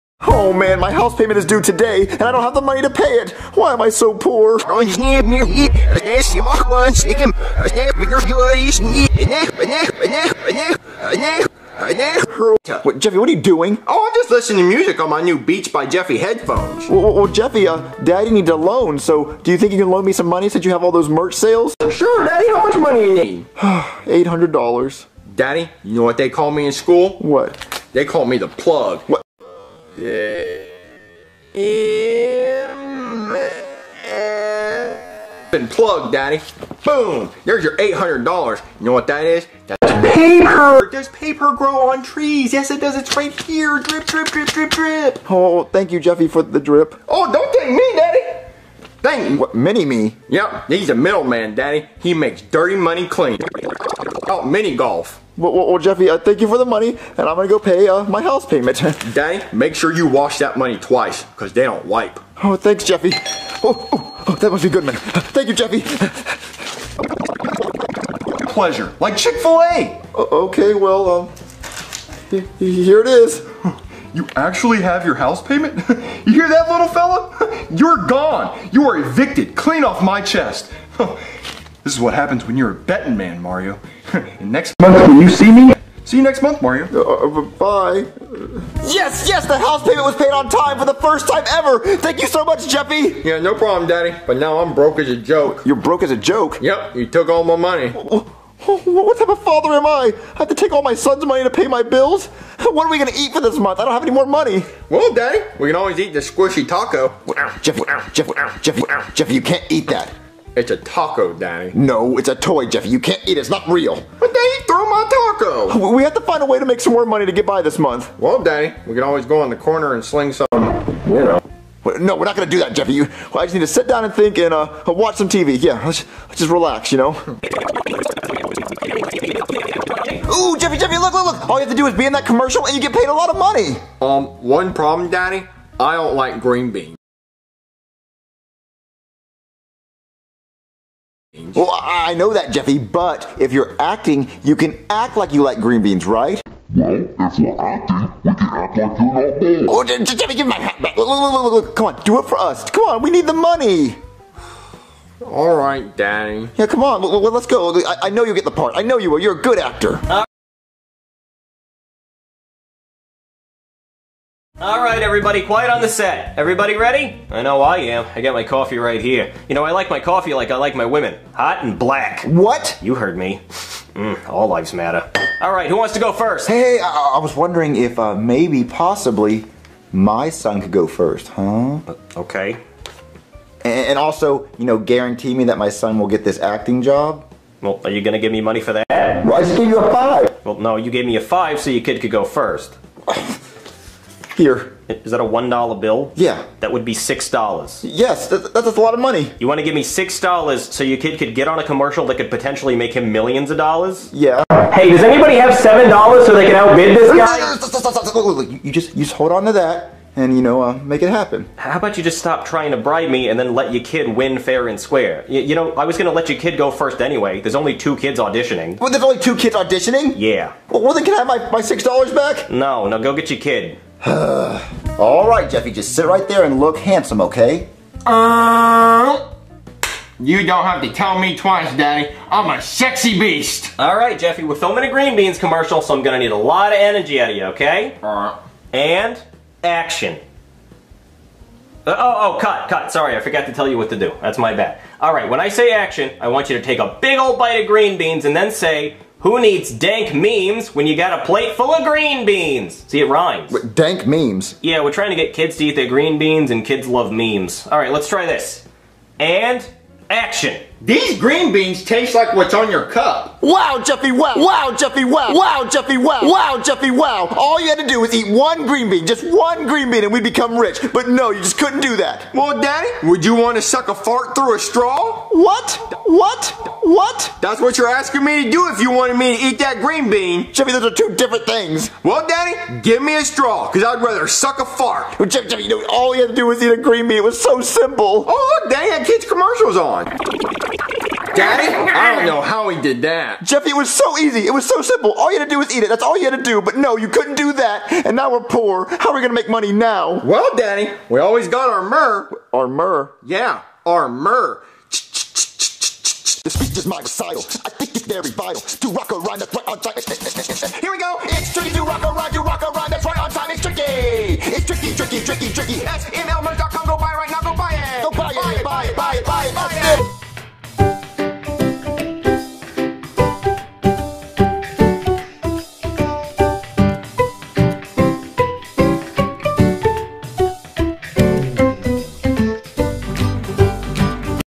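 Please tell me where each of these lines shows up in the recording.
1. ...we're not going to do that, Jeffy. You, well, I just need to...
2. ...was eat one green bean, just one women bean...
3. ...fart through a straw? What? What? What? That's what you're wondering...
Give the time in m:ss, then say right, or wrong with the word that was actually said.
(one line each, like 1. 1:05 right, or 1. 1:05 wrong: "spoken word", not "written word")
1. 2:02 right
2. 4:28 wrong: "green", not "women"
3. 4:33 wrong: "asking", not "wondering".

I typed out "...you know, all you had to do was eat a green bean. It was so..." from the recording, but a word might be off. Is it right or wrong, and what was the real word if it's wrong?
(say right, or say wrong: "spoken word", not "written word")
right.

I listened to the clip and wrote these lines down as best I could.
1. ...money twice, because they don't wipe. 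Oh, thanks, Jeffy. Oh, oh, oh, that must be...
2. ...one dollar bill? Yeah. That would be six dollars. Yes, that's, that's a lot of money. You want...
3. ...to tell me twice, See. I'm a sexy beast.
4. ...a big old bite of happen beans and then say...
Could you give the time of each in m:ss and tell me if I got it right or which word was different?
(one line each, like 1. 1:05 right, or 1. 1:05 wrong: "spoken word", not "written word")
1. 1:00 right
2. 3:15 right
3. 3:50 wrong: "Daddy", not "See"
4. 4:06 wrong: "green", not "happen".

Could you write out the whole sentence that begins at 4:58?
How are we going to make money now?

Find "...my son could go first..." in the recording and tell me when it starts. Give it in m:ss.
2:59.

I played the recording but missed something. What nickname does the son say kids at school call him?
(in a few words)
The plug.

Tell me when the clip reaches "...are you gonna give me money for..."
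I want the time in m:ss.
3:07.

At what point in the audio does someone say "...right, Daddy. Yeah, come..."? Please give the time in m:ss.
2:35.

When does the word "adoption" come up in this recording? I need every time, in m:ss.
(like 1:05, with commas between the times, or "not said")
not said.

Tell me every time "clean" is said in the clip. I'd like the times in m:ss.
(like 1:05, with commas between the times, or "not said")
0:53, 1:19.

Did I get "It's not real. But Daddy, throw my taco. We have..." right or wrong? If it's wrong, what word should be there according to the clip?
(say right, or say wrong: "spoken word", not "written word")
right.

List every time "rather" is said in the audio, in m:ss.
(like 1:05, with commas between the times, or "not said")
4:44.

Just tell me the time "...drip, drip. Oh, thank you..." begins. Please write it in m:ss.
0:44.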